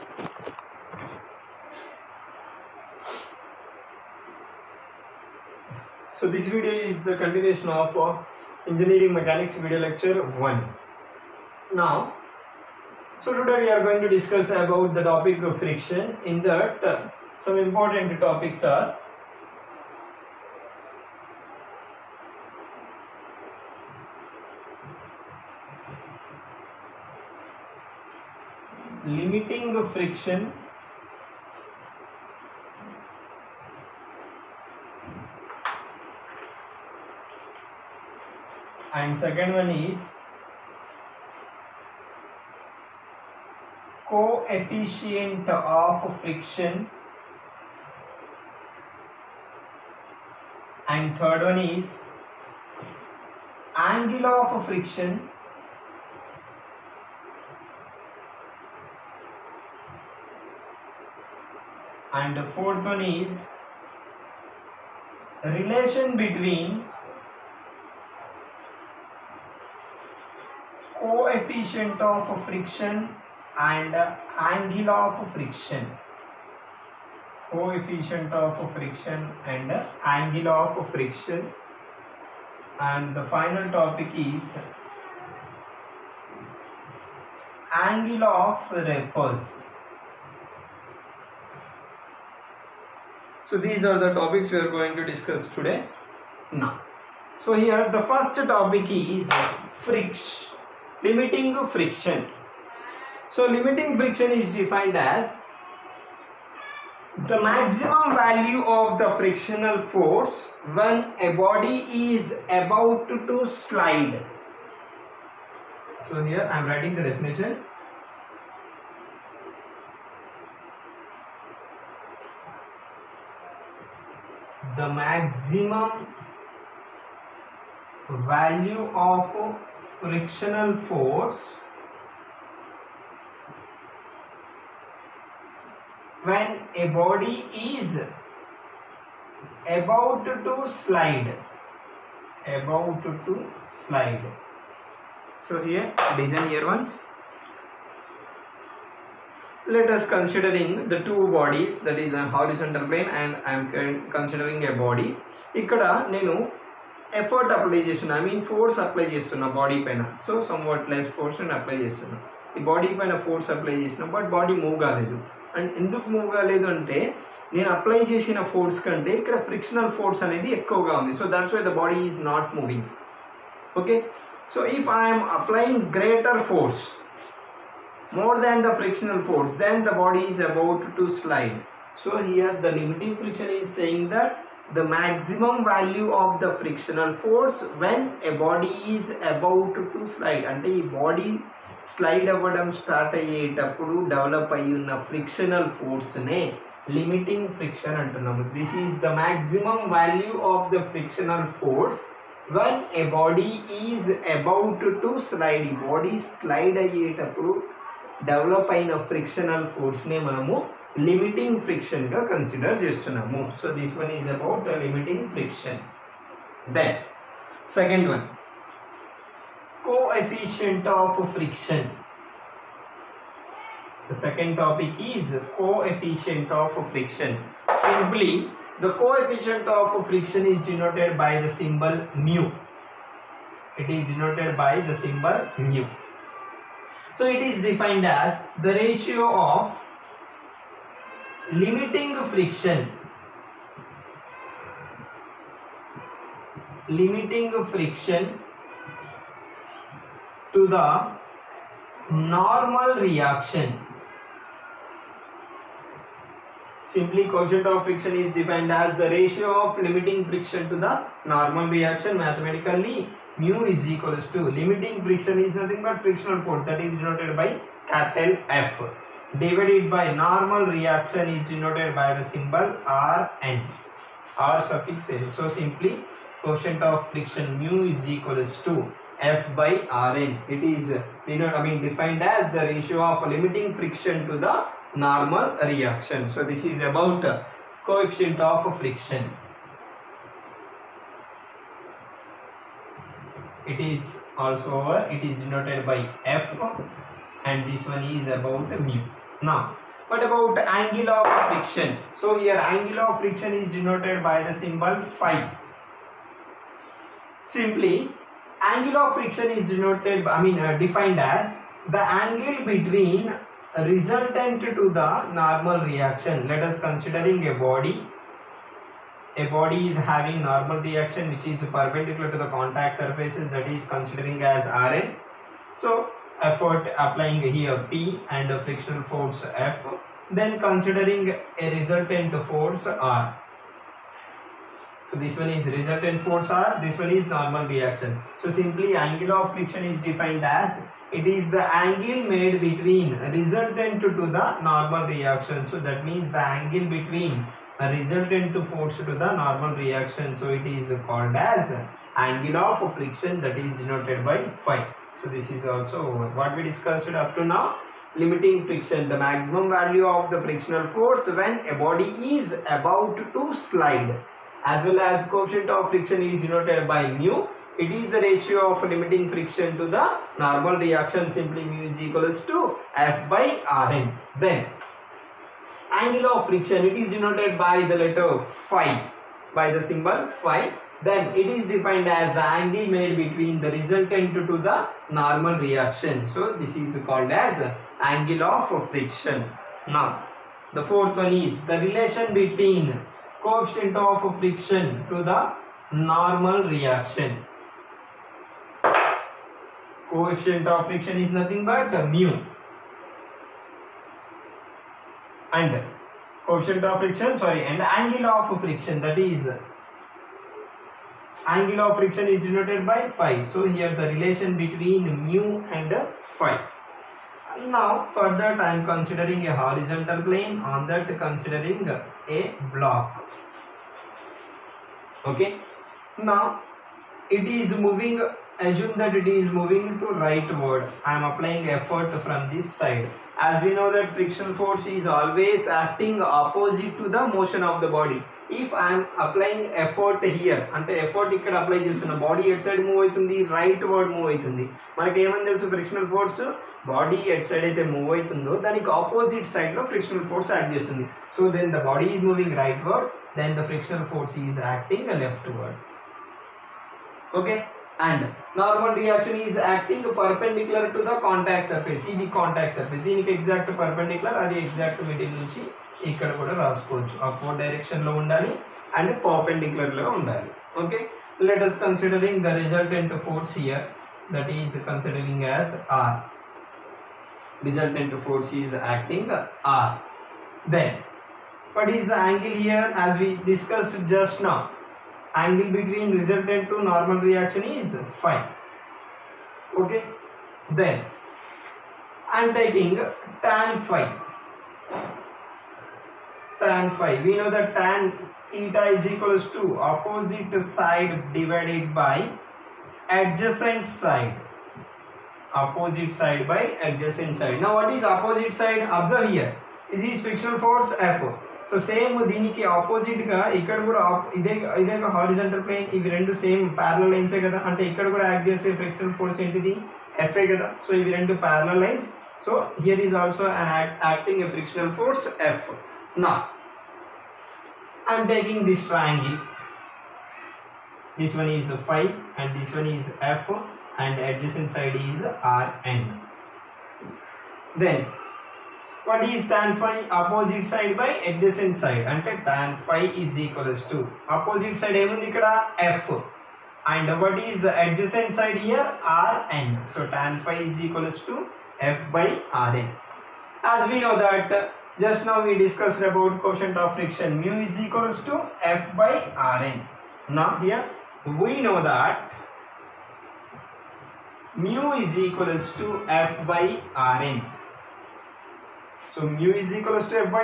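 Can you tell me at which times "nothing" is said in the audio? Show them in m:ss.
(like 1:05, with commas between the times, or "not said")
4:25, 6:41.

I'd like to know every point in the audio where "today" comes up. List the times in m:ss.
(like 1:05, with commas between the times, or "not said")
0:13, 1:35.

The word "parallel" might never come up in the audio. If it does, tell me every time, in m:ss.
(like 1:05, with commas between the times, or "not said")
8:36, 8:41.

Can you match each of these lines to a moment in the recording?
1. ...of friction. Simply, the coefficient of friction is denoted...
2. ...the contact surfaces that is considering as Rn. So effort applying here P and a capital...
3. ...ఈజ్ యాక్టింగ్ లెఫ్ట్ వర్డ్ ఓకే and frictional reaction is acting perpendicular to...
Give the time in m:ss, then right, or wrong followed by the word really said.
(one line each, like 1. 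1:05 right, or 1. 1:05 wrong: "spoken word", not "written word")
1. 3:46 right
2. 5:22 wrong: "frictional", not "capital"
3. 7:34 wrong: "normal", not "frictional".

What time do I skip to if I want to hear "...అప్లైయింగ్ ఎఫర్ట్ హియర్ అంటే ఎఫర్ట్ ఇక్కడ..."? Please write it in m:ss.
7:19.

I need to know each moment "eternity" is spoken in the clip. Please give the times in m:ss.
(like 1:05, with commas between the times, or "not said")
not said.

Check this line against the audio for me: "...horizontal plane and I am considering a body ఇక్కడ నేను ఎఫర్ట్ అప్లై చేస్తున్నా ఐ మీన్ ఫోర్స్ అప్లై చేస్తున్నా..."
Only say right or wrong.
right.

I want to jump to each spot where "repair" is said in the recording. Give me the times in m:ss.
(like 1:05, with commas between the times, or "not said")
not said.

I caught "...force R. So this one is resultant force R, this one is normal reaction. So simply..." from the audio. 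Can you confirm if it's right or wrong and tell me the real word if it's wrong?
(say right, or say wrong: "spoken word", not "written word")
right.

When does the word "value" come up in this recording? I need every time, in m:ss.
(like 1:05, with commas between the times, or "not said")
1:48, 2:08, 3:05, 5:59.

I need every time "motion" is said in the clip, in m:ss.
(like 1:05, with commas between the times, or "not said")
7:17.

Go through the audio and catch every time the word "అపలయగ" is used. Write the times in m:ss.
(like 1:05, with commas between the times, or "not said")
2:55, 7:19.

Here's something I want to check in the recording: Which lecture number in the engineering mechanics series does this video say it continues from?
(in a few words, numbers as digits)
1.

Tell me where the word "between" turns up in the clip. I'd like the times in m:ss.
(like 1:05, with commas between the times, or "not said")
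1:06, 5:12, 5:42, 5:46, 6:23, 6:32, 6:54, 8:05.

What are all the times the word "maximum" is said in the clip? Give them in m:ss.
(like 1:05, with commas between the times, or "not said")
1:47, 2:04, 3:04, 5:59.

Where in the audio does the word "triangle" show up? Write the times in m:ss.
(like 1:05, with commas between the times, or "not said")
8:48.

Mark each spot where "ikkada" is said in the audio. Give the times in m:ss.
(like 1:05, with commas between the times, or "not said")
7:46, 8:33, 8:37.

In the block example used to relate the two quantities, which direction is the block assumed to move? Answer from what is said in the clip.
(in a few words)
Rightward.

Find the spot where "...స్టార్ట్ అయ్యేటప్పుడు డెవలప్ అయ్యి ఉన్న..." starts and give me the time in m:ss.
3:12.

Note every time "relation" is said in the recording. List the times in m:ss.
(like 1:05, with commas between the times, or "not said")
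1:05, 6:31, 6:54.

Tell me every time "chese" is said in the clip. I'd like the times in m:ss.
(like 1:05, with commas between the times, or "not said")
8:38.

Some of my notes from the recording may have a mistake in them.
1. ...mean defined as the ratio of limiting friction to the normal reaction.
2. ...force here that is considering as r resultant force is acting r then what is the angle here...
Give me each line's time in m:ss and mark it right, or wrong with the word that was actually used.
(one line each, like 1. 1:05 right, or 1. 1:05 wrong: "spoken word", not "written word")
1. 4:41 right
2. 7:53 right.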